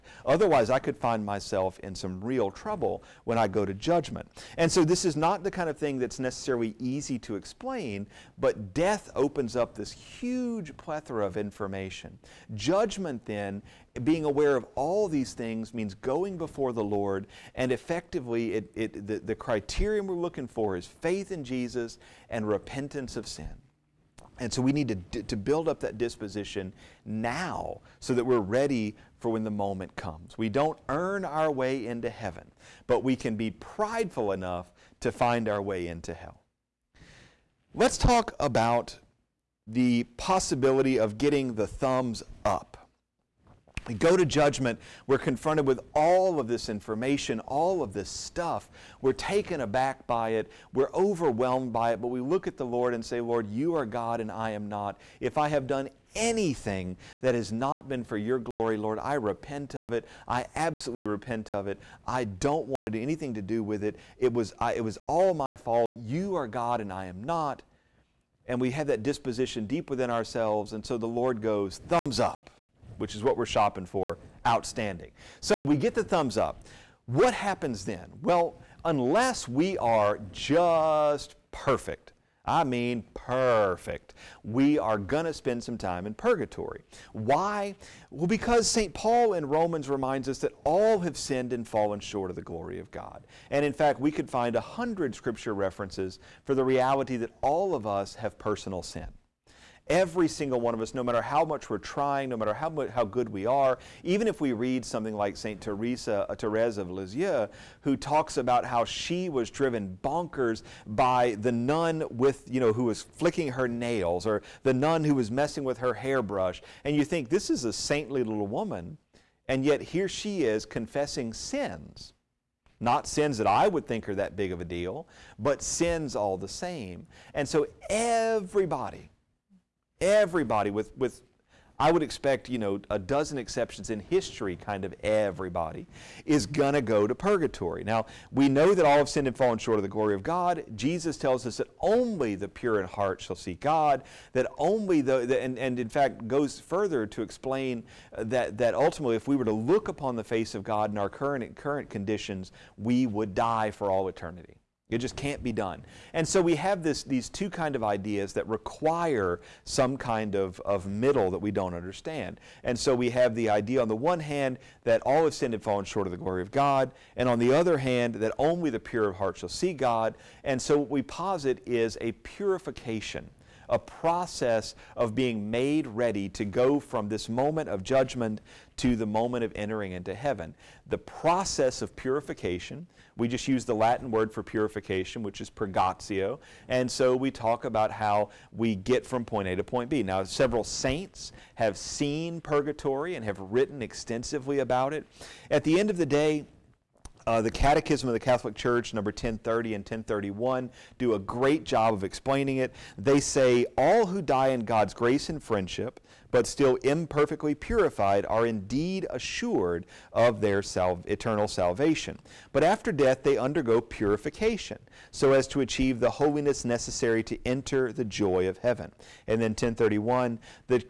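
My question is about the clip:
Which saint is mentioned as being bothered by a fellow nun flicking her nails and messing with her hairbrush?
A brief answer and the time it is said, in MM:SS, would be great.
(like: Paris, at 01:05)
Therese of Lisieux, at 01:46.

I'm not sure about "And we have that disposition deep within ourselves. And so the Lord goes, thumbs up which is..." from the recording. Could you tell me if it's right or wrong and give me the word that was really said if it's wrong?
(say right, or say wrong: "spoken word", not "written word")
right.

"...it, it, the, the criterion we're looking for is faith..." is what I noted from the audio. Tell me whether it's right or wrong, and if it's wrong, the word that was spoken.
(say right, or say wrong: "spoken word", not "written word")
right.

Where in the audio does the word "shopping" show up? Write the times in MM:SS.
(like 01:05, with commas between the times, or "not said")
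01:13.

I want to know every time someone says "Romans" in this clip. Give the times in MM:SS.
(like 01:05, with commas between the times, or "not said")
01:29.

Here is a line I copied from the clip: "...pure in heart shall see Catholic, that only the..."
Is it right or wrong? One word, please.
wrong.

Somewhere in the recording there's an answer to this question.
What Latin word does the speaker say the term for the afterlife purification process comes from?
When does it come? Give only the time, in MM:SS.
03:05.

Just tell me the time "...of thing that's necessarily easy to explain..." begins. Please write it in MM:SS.
00:05.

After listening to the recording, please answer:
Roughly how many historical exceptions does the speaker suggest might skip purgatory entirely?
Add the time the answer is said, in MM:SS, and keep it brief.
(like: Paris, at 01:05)
a dozen, at 02:12.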